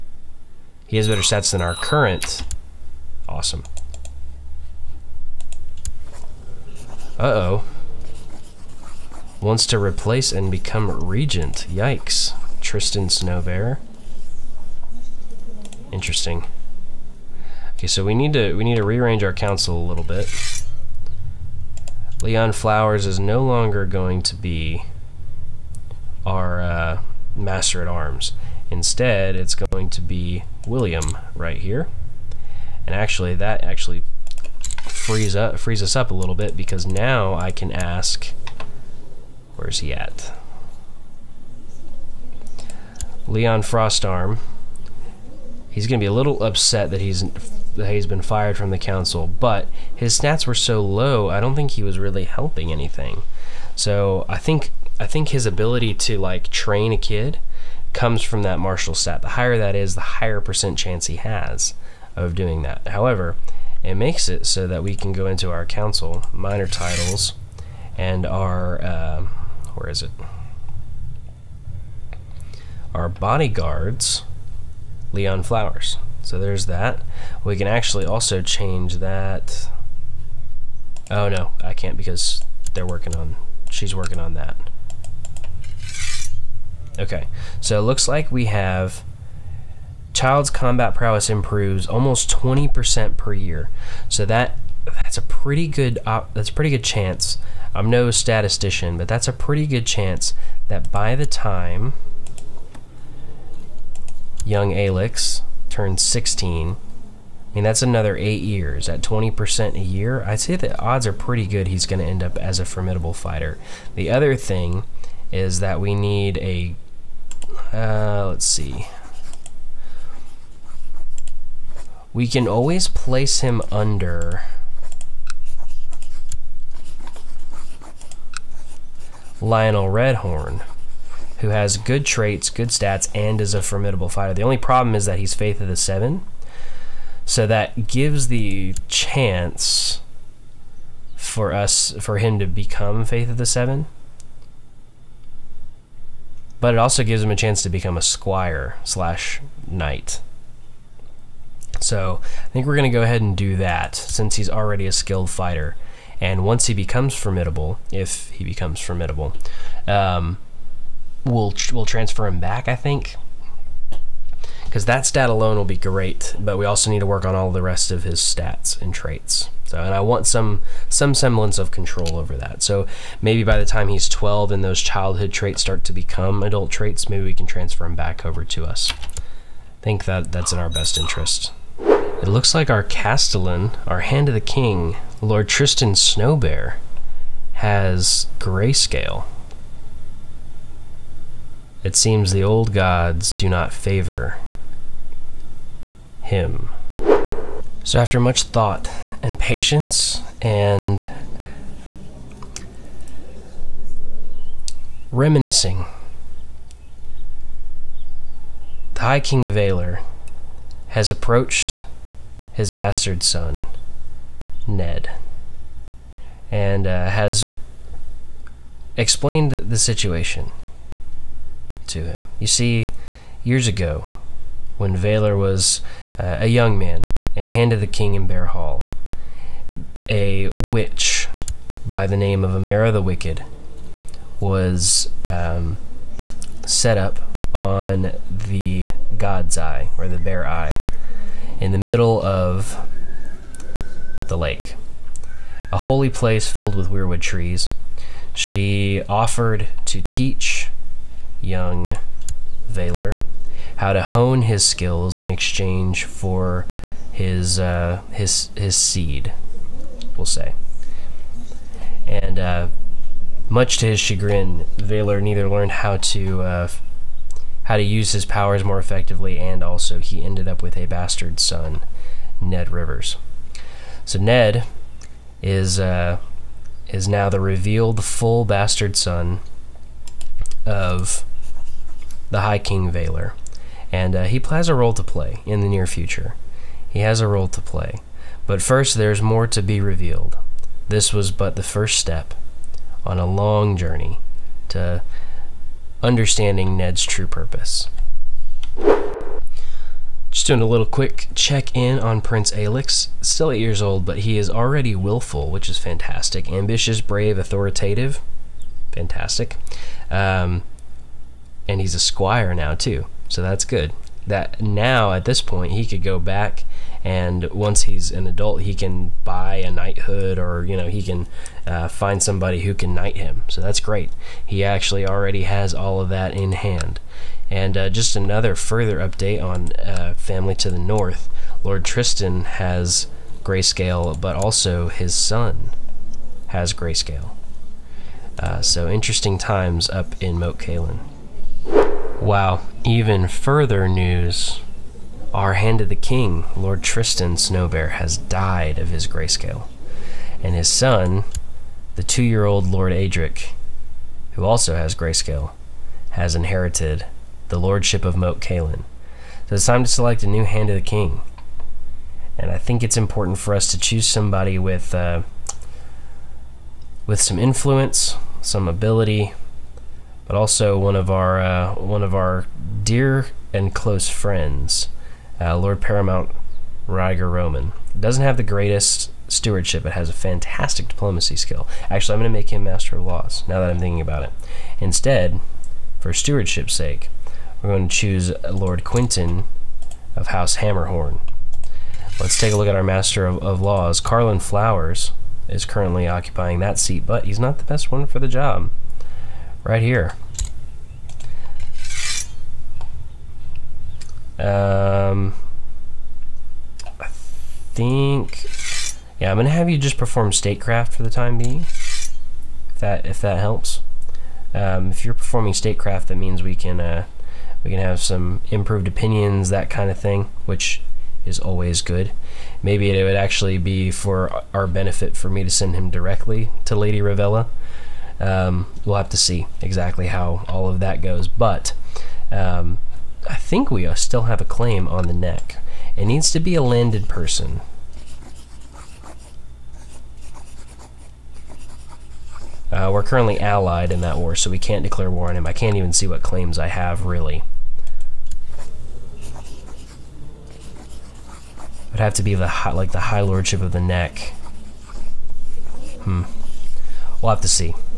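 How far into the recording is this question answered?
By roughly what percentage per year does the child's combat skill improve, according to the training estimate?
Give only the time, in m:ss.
1:32.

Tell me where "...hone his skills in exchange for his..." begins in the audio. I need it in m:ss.
4:14.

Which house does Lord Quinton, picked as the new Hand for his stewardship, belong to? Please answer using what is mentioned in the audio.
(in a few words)
House Hammerhorn.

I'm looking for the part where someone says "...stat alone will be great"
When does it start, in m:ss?
2:45.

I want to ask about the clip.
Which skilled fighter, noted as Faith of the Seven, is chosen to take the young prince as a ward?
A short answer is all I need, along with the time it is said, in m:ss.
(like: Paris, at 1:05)
Lionel Redhorn, at 2:09.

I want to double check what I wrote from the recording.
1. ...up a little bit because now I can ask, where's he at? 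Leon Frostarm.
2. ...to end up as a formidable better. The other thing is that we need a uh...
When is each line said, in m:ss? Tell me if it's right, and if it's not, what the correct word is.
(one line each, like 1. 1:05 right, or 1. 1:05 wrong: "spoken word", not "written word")
1. 0:35 right
2. 1:51 wrong: "fighter", not "better".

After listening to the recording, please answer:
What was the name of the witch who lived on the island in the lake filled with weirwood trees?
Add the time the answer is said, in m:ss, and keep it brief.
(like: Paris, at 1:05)
Amara the Wicked, at 3:52.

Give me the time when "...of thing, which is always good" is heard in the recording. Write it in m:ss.
6:59.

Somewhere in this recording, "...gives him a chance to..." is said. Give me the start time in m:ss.
2:27.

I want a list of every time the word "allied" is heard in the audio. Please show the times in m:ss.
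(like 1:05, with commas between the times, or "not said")
7:23.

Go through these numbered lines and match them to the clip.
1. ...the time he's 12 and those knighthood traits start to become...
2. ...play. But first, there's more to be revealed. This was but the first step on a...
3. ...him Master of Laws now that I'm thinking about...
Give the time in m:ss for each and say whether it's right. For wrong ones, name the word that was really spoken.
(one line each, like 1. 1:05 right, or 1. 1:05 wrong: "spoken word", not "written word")
1. 2:53 wrong: "childhood", not "knighthood"
2. 4:47 right
3. 6:22 right.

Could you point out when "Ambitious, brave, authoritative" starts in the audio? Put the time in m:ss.
5:06.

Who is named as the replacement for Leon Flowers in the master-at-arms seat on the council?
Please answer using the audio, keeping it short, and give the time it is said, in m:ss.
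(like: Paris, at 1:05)
William, at 0:30.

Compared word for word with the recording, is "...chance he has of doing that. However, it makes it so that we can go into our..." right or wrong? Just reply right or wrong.
right.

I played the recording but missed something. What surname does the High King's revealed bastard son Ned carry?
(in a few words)
Rivers.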